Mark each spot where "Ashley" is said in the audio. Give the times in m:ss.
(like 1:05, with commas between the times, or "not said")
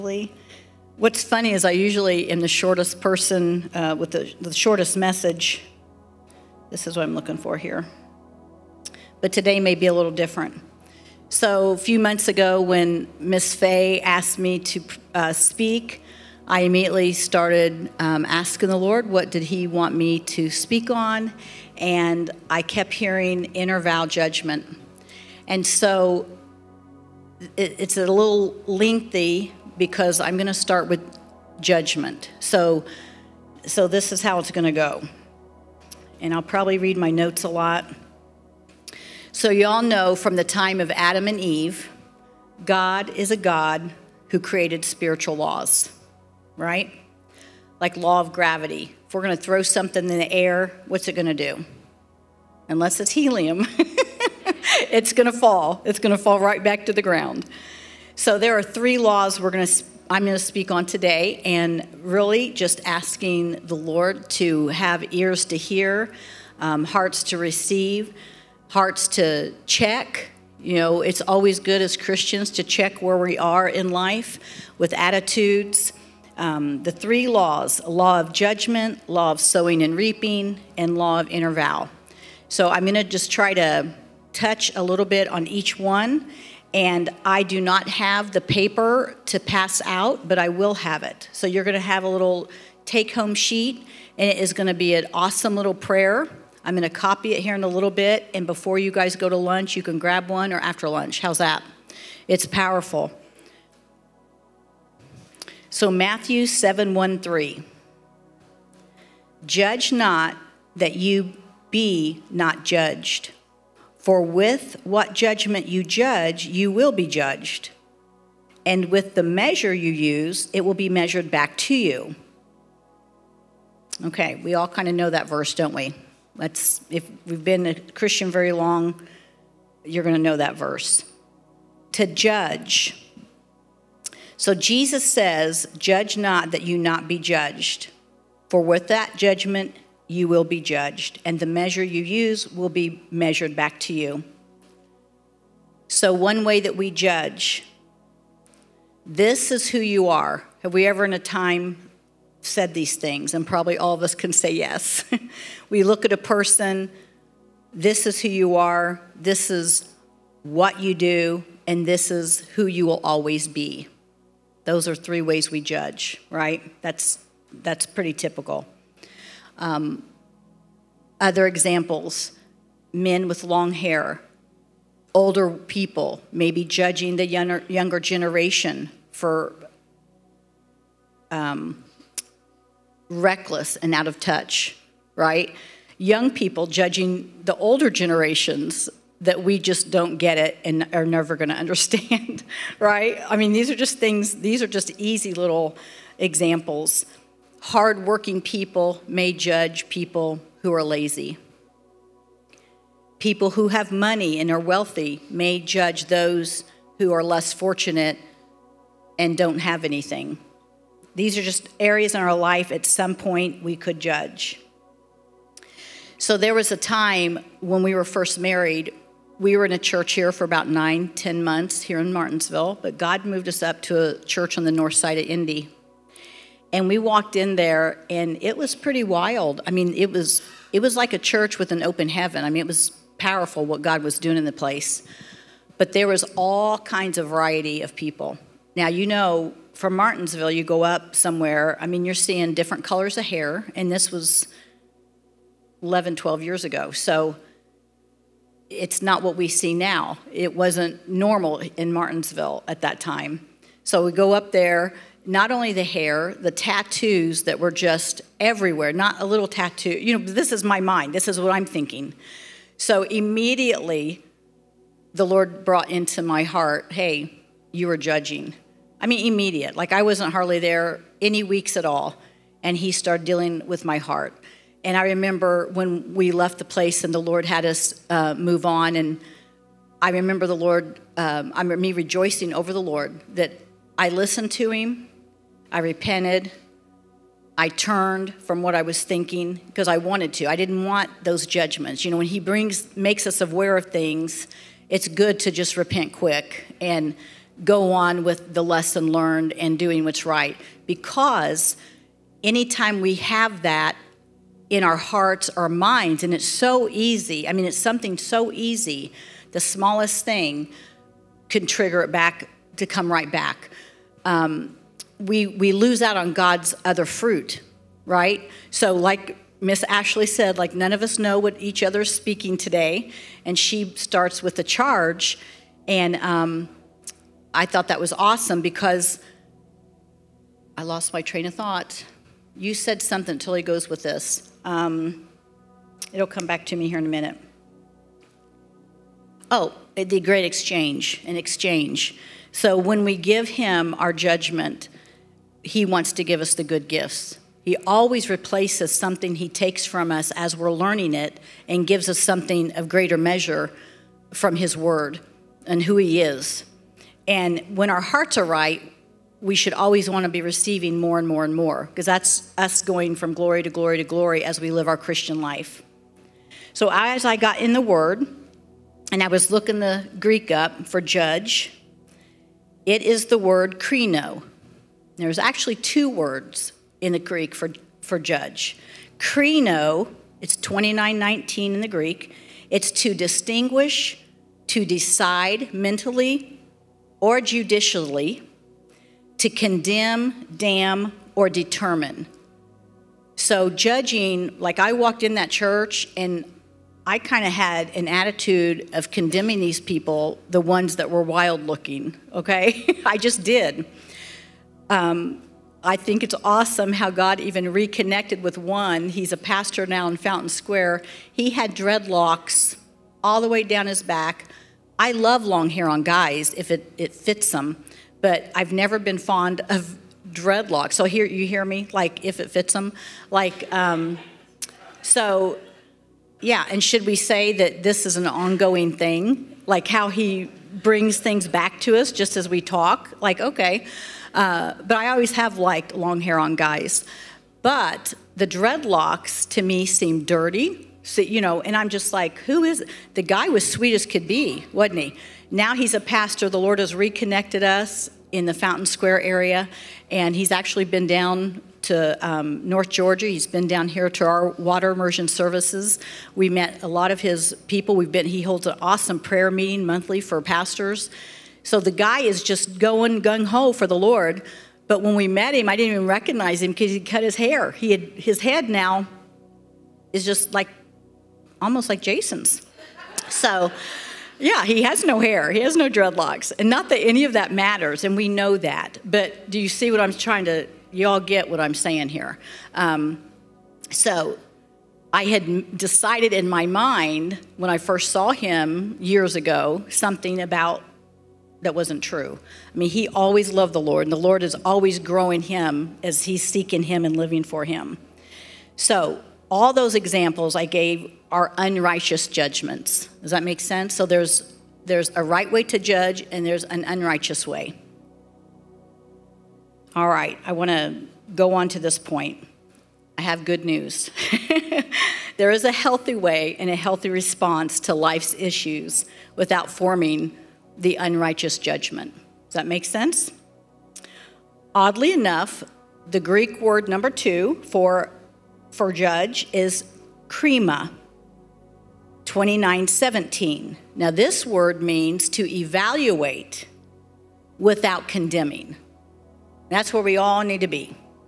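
5:19.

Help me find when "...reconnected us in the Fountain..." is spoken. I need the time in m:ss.
7:26.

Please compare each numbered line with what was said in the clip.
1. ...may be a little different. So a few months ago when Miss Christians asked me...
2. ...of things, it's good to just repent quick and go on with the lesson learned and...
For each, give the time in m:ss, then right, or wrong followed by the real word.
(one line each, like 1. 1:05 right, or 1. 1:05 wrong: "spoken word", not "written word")
1. 0:09 wrong: "Fay", not "Christians"
2. 4:53 right.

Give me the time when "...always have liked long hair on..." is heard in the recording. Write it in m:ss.
7:15.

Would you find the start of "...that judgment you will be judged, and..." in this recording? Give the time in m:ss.
2:18.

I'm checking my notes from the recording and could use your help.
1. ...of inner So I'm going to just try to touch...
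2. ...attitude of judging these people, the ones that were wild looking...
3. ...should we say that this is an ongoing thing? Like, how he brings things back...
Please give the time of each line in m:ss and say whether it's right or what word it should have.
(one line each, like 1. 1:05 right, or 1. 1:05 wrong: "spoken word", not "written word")
1. 1:21 right
2. 6:38 wrong: "condemning", not "judging"
3. 7:06 right.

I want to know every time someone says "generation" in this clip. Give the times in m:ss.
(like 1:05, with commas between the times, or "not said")
2:57, 3:07.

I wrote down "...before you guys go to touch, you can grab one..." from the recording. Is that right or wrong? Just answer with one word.
wrong.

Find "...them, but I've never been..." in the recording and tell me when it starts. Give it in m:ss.
6:57.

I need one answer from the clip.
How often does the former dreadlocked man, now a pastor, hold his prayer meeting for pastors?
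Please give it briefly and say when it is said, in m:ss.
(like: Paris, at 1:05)
Monthly, at 7:39.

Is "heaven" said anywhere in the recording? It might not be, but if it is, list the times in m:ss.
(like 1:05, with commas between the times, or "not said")
3:52.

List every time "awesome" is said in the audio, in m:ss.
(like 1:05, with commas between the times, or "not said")
1:35, 5:28, 6:46, 7:38.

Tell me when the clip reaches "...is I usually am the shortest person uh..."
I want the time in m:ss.
0:01.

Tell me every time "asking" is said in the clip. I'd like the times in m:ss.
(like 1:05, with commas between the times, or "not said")
0:18, 1:02.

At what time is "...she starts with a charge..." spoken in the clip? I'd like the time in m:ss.
5:23.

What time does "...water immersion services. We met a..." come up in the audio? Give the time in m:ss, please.
7:34.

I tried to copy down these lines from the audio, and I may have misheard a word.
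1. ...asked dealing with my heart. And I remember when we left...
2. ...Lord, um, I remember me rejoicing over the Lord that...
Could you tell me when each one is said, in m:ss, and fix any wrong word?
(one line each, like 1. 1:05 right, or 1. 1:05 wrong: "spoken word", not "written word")
1. 4:32 wrong: "started", not "asked"
2. 4:40 right.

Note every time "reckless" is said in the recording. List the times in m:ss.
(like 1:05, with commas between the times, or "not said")
3:03.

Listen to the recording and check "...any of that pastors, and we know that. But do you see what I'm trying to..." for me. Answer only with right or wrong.
wrong.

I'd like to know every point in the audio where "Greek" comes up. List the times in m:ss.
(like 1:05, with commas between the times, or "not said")
6:10, 6:17, 6:21, 8:46.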